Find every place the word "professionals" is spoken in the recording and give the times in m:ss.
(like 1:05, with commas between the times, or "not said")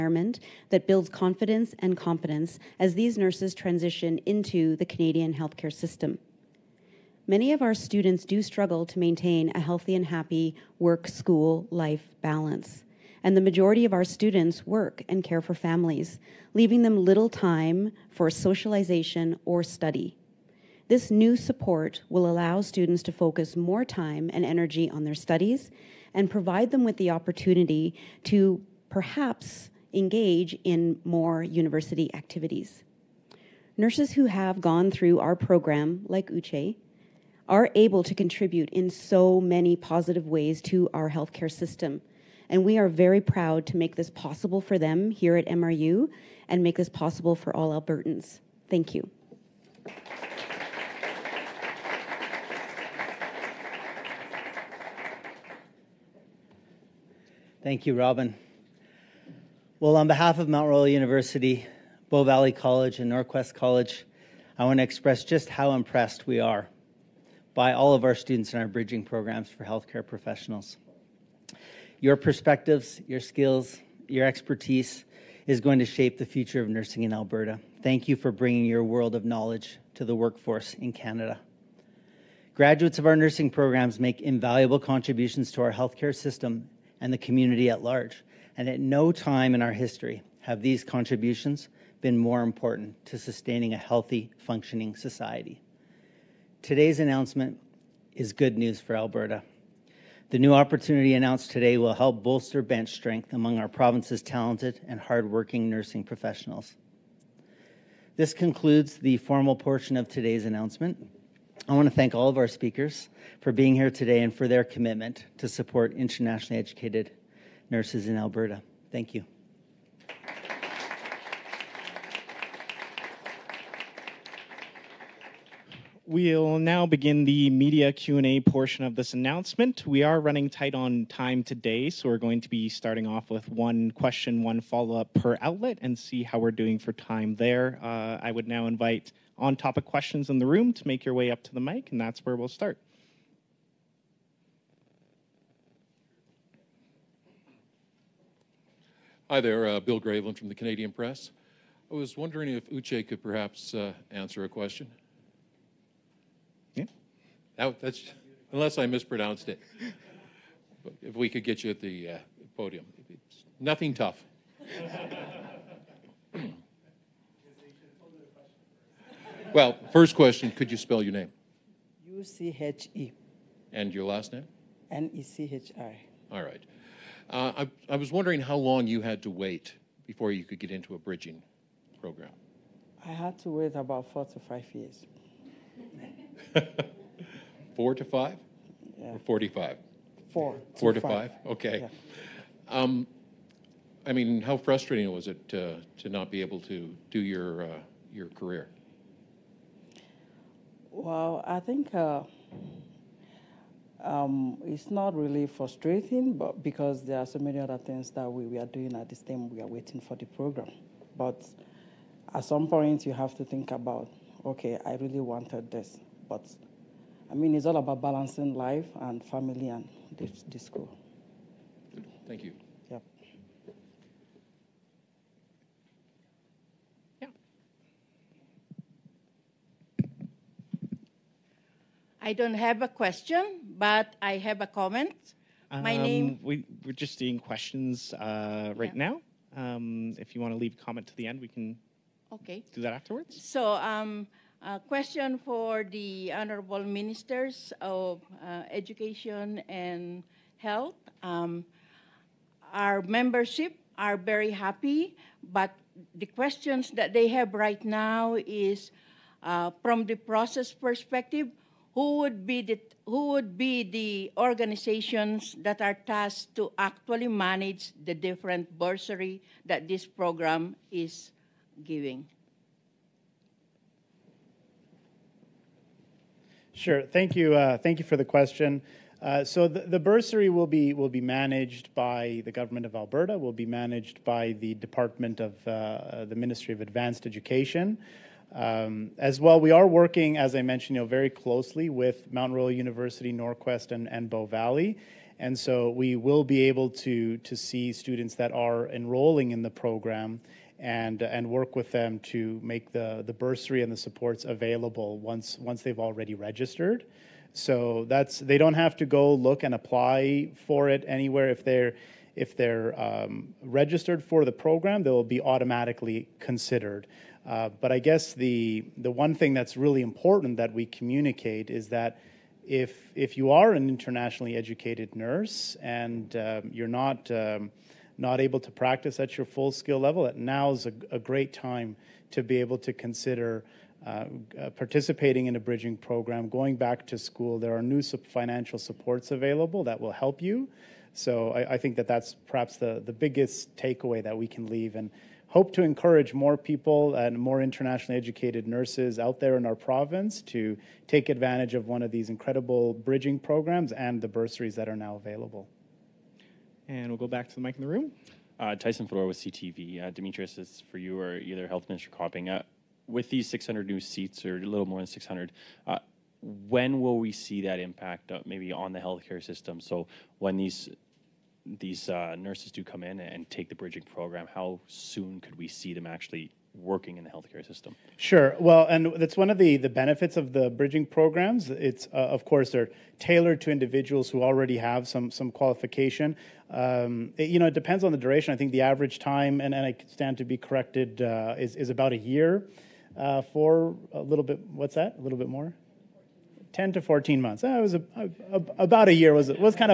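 1:10, 1:46.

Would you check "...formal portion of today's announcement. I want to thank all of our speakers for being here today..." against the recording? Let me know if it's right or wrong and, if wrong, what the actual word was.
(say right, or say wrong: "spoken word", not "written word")
right.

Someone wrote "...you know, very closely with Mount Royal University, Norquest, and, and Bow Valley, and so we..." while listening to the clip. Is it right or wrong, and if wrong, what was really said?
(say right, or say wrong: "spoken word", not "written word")
right.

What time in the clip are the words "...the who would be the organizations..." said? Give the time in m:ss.
4:22.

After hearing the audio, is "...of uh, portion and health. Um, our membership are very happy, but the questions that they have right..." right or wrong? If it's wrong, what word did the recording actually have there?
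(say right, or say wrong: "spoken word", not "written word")
wrong: "education", not "portion".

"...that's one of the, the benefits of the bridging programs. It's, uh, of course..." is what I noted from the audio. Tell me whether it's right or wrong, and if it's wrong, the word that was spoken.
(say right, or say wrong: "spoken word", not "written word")
right.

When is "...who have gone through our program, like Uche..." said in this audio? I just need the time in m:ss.
0:34.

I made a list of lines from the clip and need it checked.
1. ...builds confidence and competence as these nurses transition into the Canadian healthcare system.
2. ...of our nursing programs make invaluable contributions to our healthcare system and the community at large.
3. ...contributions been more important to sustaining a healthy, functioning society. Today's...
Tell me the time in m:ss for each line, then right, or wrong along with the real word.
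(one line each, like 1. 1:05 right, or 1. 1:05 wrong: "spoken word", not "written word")
1. 0:00 right
2. 1:22 right
3. 1:30 right.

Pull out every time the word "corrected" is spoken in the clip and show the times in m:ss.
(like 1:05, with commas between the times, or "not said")
6:30.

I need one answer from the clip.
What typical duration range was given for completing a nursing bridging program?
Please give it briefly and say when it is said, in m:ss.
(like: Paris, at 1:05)
10 to 14 months, at 6:36.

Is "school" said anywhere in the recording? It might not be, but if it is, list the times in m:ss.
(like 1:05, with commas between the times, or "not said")
0:11, 3:40, 5:37.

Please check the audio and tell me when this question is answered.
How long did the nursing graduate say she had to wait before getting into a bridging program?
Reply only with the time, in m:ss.
3:04.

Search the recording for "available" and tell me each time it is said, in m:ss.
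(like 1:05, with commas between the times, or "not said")
5:04, 5:39, 5:55.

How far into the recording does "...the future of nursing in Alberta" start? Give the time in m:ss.
1:16.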